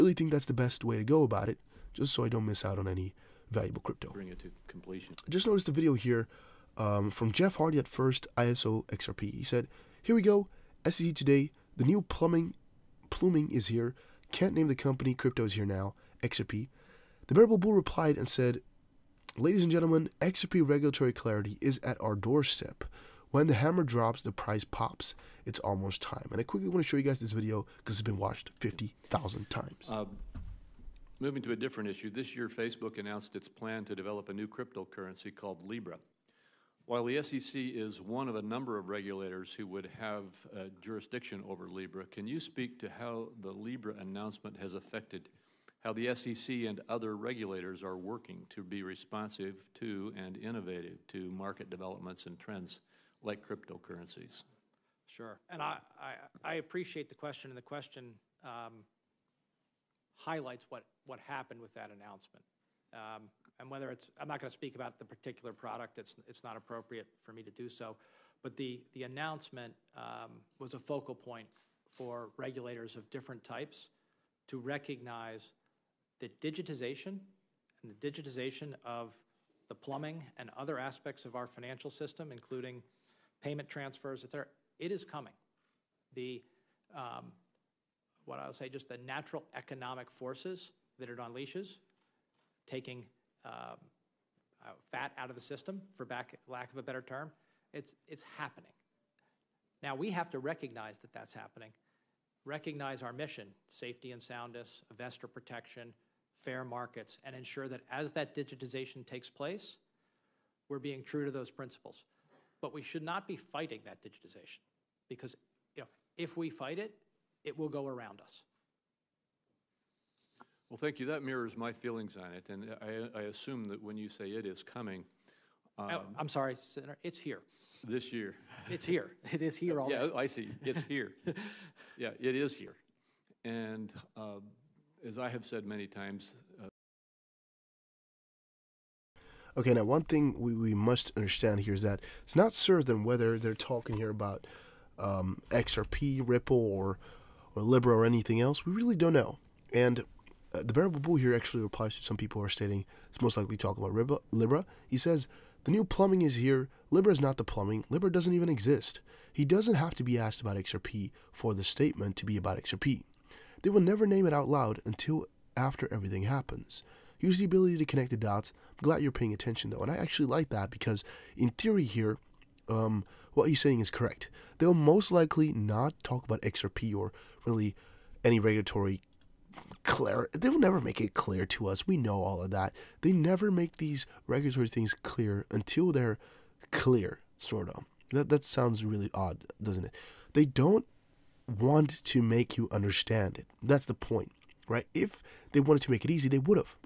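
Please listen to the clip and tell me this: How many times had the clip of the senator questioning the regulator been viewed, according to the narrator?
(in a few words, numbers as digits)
50,000.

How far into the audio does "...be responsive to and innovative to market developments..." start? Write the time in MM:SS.
00:48.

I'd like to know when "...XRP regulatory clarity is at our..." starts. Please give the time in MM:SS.
00:20.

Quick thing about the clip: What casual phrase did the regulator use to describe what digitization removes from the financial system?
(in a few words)
fat.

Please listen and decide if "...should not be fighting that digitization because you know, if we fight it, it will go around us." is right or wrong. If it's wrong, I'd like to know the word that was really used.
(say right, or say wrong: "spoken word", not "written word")
right.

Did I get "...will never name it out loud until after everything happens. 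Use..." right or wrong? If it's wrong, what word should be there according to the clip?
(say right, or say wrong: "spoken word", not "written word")
right.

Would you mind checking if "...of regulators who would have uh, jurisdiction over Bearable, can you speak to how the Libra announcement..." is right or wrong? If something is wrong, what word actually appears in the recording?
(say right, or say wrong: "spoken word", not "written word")
wrong: "Libra", not "Bearable".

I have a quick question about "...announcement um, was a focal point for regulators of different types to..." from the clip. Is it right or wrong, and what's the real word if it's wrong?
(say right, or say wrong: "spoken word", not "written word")
right.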